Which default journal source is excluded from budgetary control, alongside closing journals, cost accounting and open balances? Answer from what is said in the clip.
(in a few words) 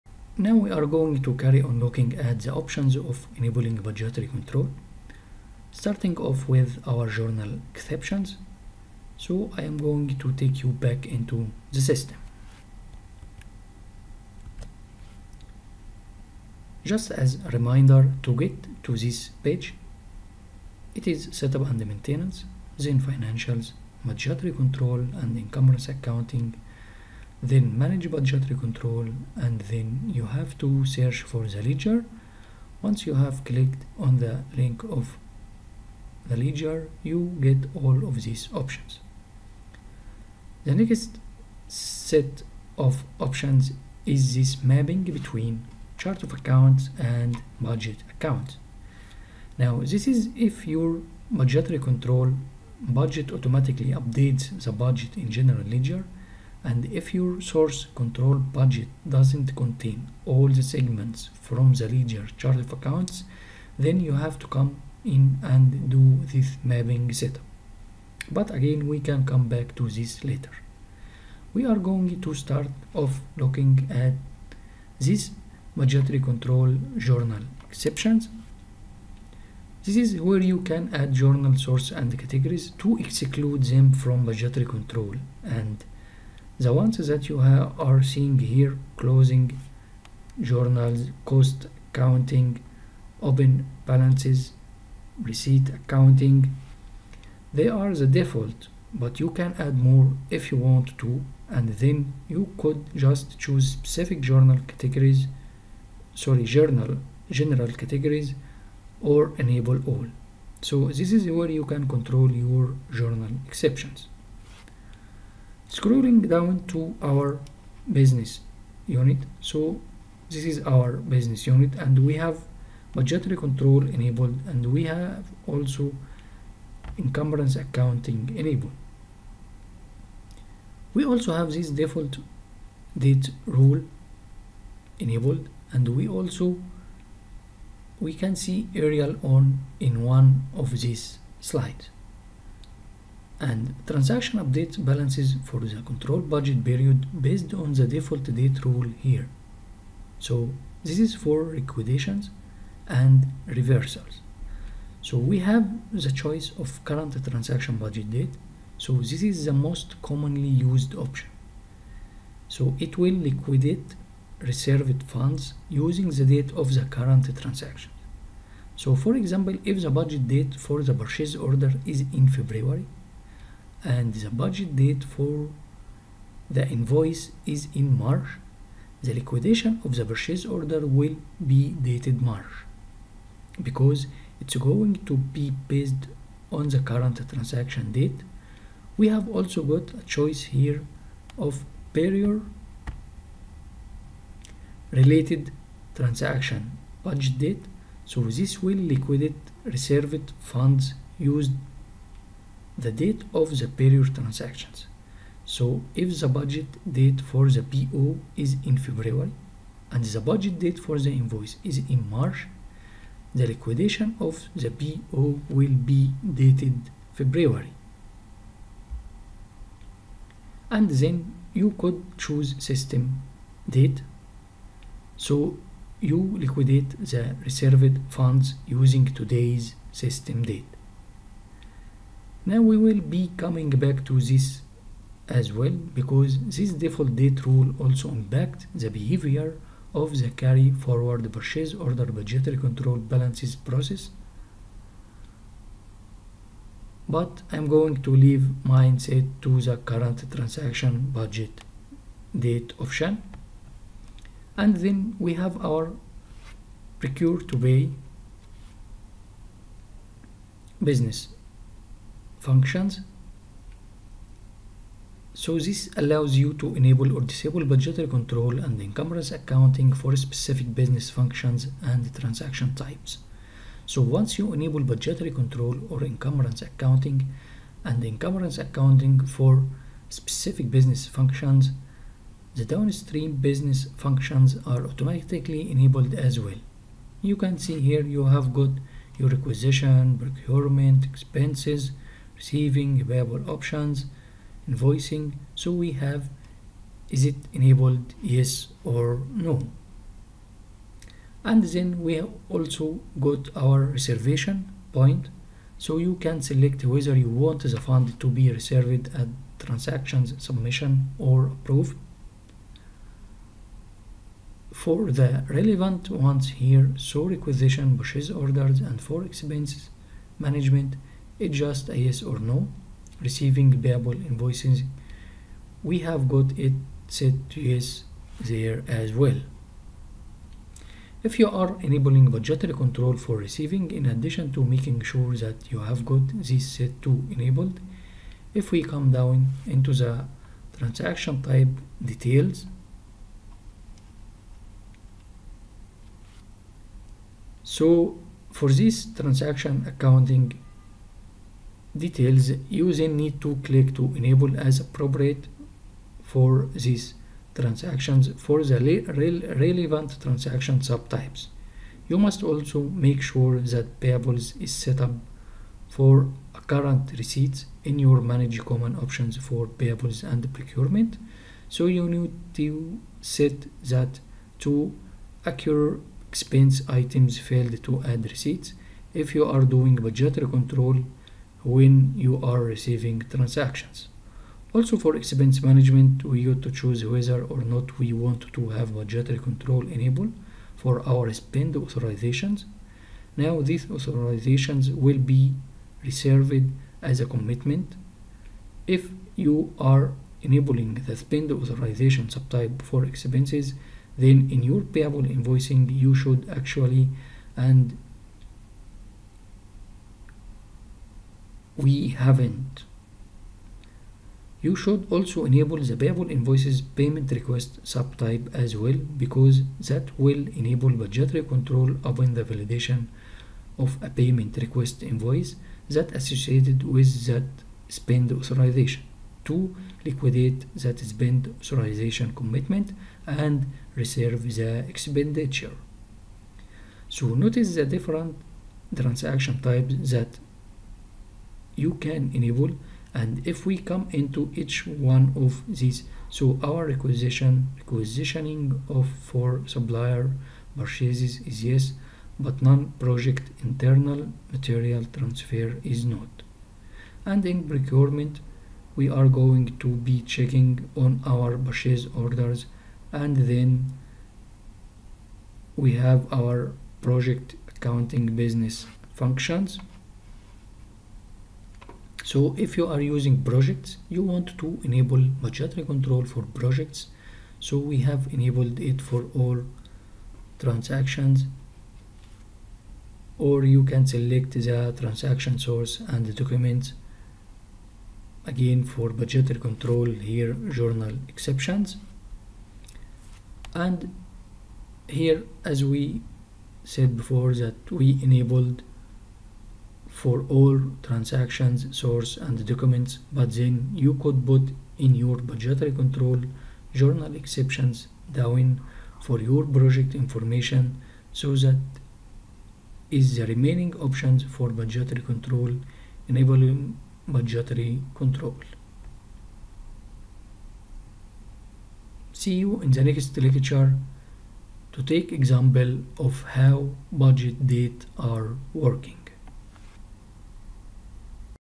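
Receipt accounting.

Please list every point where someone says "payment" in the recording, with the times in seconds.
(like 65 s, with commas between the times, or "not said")
416 s, 424 s.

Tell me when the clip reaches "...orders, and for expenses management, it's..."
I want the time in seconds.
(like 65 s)
318 s.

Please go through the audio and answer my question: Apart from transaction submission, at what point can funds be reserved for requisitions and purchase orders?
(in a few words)
Approve.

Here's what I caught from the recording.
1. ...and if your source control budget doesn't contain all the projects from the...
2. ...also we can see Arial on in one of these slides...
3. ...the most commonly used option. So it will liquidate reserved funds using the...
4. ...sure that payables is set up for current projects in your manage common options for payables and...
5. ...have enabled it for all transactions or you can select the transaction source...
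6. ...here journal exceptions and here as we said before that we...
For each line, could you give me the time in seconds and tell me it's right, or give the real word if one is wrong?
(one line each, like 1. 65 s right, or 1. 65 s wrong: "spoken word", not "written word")
1. 56 s wrong: "segments", not "projects"
2. 136 s right
3. 159 s right
4. 363 s wrong: "receipts", not "projects"
5. 478 s right
6. 490 s right.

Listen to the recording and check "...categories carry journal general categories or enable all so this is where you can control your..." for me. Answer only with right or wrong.
wrong.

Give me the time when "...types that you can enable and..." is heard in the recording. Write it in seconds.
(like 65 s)
439 s.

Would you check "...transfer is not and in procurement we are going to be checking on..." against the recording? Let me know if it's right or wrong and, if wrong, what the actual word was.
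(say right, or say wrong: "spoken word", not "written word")
right.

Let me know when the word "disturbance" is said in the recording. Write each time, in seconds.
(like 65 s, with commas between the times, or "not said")
not said.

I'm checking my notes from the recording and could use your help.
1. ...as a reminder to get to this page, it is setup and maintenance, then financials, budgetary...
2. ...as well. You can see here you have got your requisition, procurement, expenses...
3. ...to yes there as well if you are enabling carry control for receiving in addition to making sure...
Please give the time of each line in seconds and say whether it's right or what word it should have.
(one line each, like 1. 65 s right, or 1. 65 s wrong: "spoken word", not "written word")
1. 17 s right
2. 286 s right
3. 327 s wrong: "budgetary", not "carry".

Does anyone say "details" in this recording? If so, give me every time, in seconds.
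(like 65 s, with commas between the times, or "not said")
342 s, 351 s.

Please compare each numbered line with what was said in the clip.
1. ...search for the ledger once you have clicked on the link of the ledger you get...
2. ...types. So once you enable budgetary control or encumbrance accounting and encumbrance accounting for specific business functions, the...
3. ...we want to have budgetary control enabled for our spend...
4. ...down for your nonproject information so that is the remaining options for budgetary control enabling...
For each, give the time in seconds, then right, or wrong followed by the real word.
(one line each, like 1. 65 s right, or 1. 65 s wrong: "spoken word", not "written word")
1. 30 s right
2. 272 s right
3. 387 s right
4. 508 s wrong: "project", not "nonproject".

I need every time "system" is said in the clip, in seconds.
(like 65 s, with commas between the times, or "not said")
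11 s, 222 s, 229 s.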